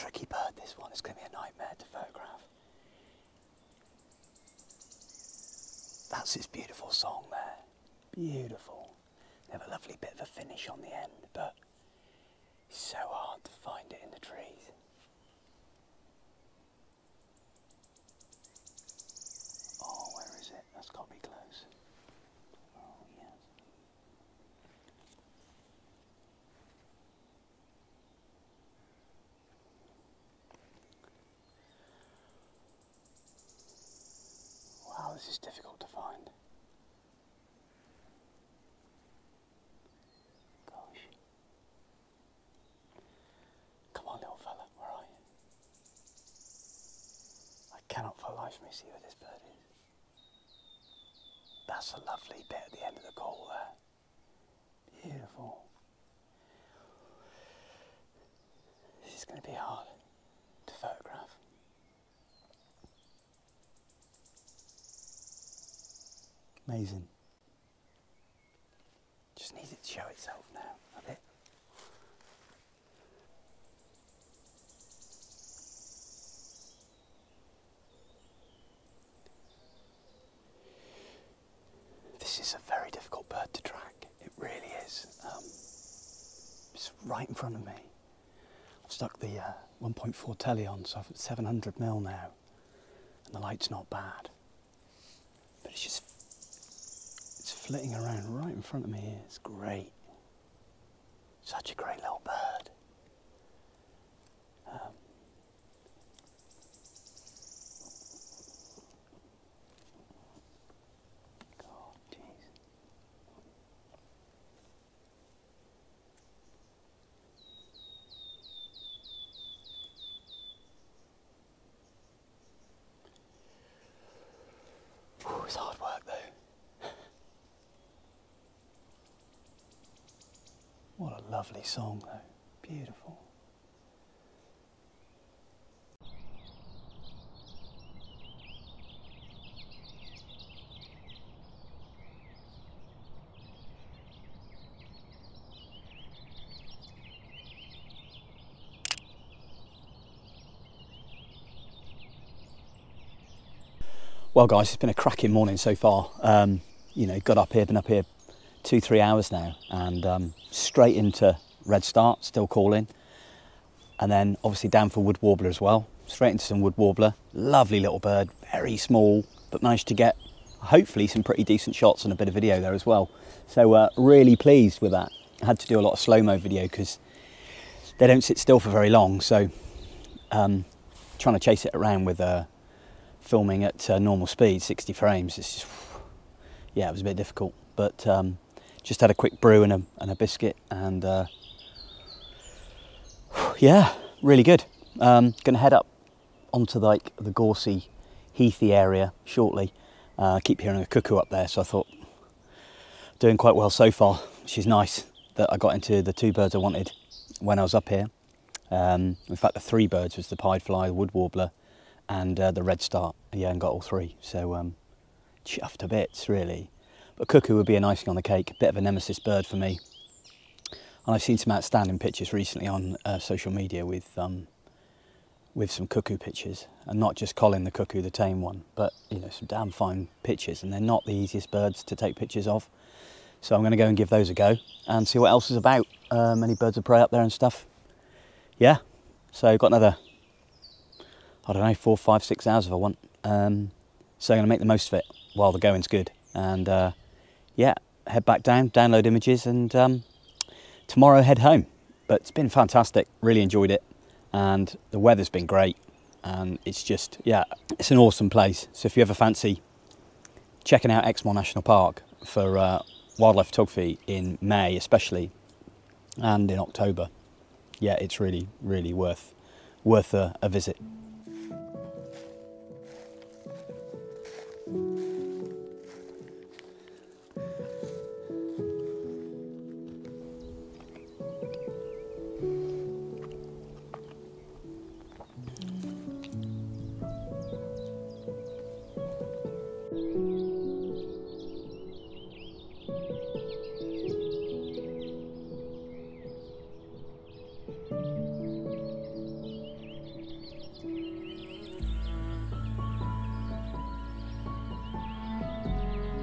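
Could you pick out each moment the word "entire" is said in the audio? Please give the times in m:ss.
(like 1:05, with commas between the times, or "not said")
not said.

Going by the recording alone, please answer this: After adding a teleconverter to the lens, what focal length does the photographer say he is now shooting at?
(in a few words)
700mm.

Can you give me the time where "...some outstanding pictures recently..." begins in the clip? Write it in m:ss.
3:41.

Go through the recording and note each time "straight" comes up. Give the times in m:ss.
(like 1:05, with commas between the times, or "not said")
2:40, 2:46.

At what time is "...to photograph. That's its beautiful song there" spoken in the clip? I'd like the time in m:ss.
0:01.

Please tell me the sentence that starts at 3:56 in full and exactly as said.
Um, any birds of prey up there and stuff.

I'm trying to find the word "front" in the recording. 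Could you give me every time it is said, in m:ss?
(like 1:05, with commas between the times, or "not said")
1:27, 1:38.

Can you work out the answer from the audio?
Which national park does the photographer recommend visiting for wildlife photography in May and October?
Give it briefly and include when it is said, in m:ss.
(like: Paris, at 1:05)
Exmoor National Park, at 4:21.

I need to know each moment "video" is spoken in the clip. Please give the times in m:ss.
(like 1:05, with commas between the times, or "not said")
2:52, 2:56.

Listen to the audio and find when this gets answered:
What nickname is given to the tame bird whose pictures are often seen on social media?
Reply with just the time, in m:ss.
3:47.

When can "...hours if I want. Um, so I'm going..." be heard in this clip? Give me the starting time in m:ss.
4:02.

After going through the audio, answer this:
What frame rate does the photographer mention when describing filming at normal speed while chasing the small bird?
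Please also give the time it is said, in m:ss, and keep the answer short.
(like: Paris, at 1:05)
60 frames, at 3:04.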